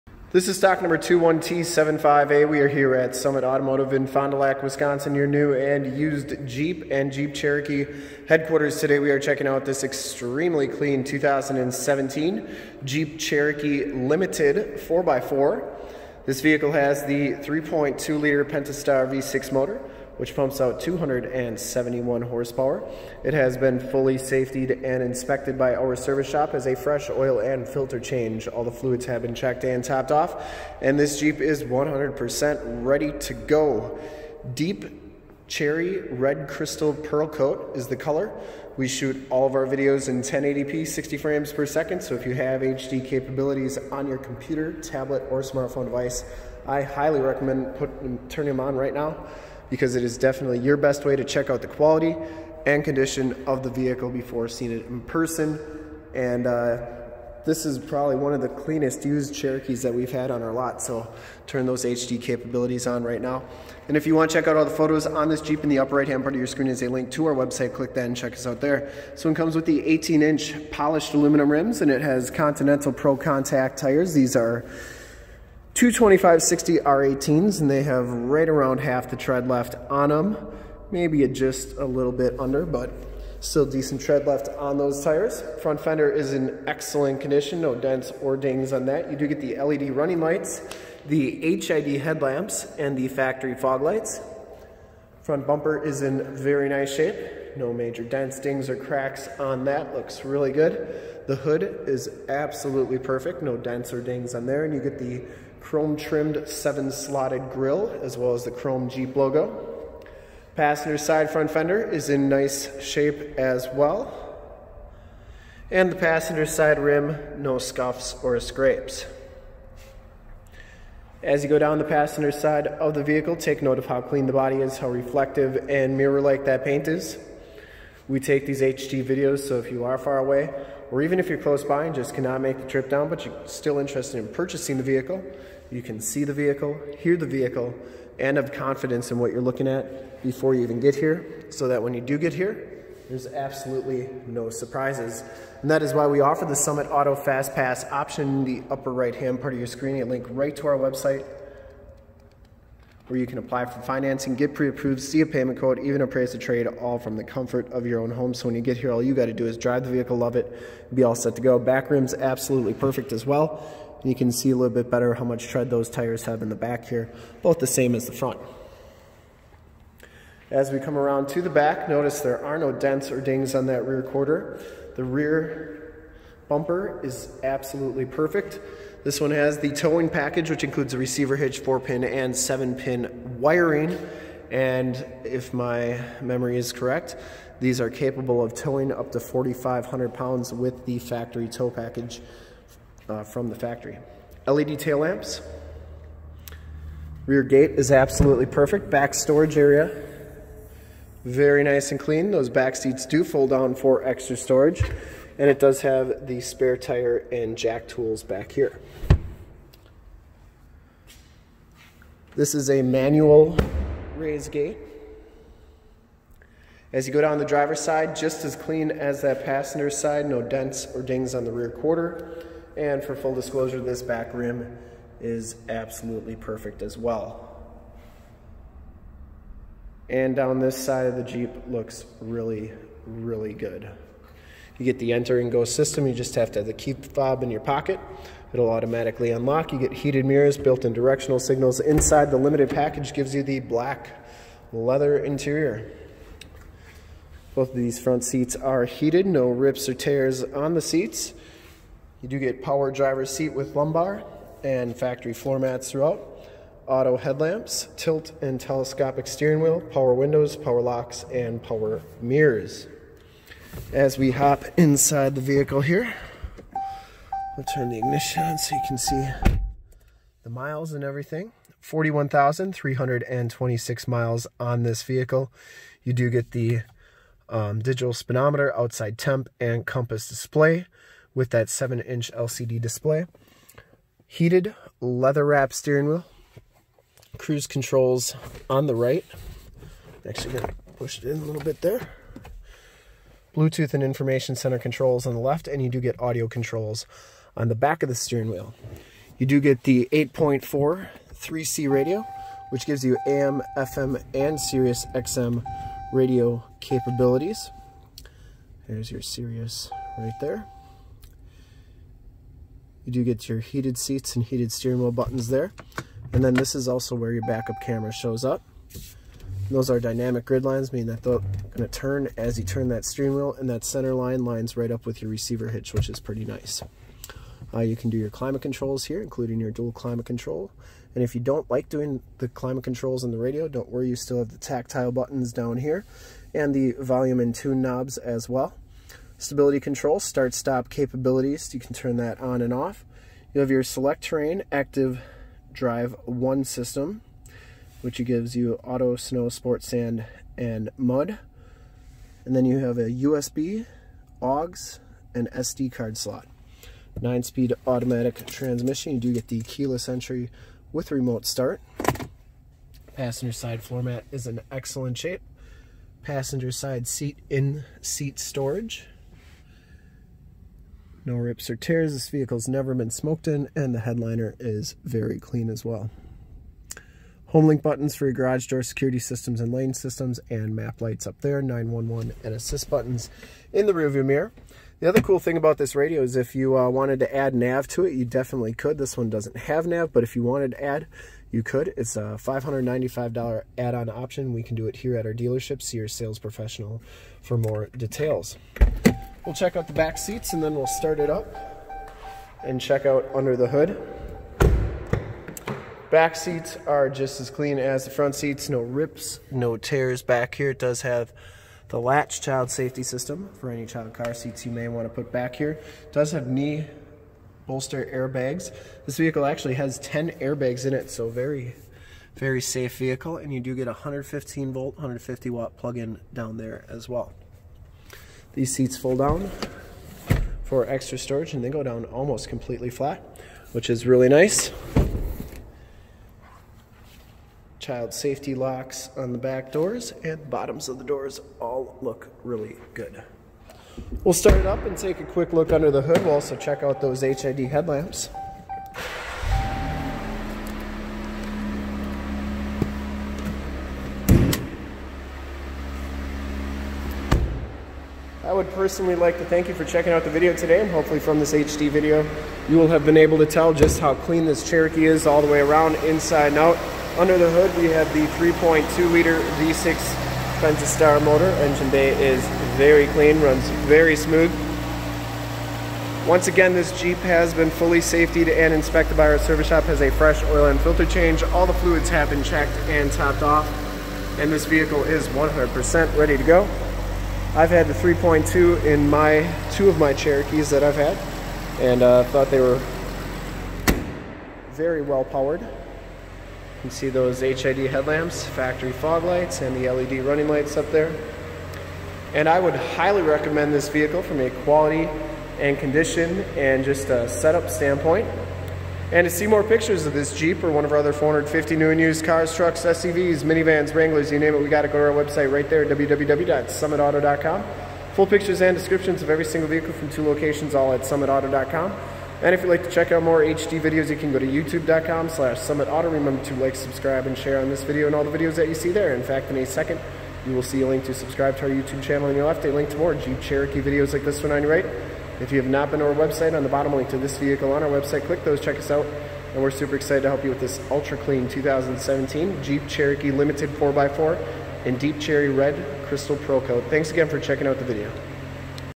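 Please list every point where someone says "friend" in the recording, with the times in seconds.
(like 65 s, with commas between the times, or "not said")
not said.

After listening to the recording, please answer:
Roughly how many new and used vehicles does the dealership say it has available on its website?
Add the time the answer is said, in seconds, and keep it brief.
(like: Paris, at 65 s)
450, at 511 s.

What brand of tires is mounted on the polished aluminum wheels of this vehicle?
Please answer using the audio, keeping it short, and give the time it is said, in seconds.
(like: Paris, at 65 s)
Continental, at 72 s.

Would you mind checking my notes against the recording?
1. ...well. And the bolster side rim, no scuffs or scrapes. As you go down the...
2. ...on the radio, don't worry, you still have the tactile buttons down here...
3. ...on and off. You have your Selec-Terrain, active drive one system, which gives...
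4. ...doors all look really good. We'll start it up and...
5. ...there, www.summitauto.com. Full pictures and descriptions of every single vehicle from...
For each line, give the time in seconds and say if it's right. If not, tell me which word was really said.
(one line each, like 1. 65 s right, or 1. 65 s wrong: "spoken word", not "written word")
1. 113 s wrong: "passenger", not "bolster"
2. 333 s right
3. 342 s right
4. 441 s right
5. 515 s right.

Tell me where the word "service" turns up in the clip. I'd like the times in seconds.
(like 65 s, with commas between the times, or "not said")
25 s, 479 s.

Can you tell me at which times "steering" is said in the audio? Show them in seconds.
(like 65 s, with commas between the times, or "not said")
259 s, 285 s, 298 s, 314 s, 323 s.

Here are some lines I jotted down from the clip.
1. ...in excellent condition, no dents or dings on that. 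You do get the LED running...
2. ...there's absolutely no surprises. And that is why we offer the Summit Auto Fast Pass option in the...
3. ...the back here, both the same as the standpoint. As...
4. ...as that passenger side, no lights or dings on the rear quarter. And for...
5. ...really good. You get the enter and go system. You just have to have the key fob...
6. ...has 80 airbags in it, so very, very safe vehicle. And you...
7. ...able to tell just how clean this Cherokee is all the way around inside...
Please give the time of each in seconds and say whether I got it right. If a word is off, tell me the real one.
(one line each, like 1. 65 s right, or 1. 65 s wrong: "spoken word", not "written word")
1. 86 s right
2. 143 s right
3. 166 s wrong: "front", not "standpoint"
4. 218 s wrong: "dents", not "lights"
5. 233 s right
6. 419 s wrong: "10", not "80"
7. 463 s right.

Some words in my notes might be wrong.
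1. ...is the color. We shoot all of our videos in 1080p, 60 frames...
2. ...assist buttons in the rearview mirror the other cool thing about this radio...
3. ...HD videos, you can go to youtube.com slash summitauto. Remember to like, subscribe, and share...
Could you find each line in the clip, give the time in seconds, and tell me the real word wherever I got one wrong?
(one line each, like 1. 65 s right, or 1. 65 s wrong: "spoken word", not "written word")
1. 37 s right
2. 382 s right
3. 523 s right.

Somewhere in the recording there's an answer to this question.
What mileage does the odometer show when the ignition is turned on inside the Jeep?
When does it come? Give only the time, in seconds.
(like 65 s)
271 s.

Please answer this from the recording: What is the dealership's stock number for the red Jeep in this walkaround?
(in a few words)
21T75A.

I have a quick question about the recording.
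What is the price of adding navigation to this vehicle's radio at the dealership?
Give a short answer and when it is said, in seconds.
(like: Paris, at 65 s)
$595, at 392 s.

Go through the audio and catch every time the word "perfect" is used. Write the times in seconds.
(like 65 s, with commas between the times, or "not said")
102 s, 162 s, 178 s, 198 s, 226 s.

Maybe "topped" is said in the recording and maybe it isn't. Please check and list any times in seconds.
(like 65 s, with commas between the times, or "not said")
29 s, 483 s.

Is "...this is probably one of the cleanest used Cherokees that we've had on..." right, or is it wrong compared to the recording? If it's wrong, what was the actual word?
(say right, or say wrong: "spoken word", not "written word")
right.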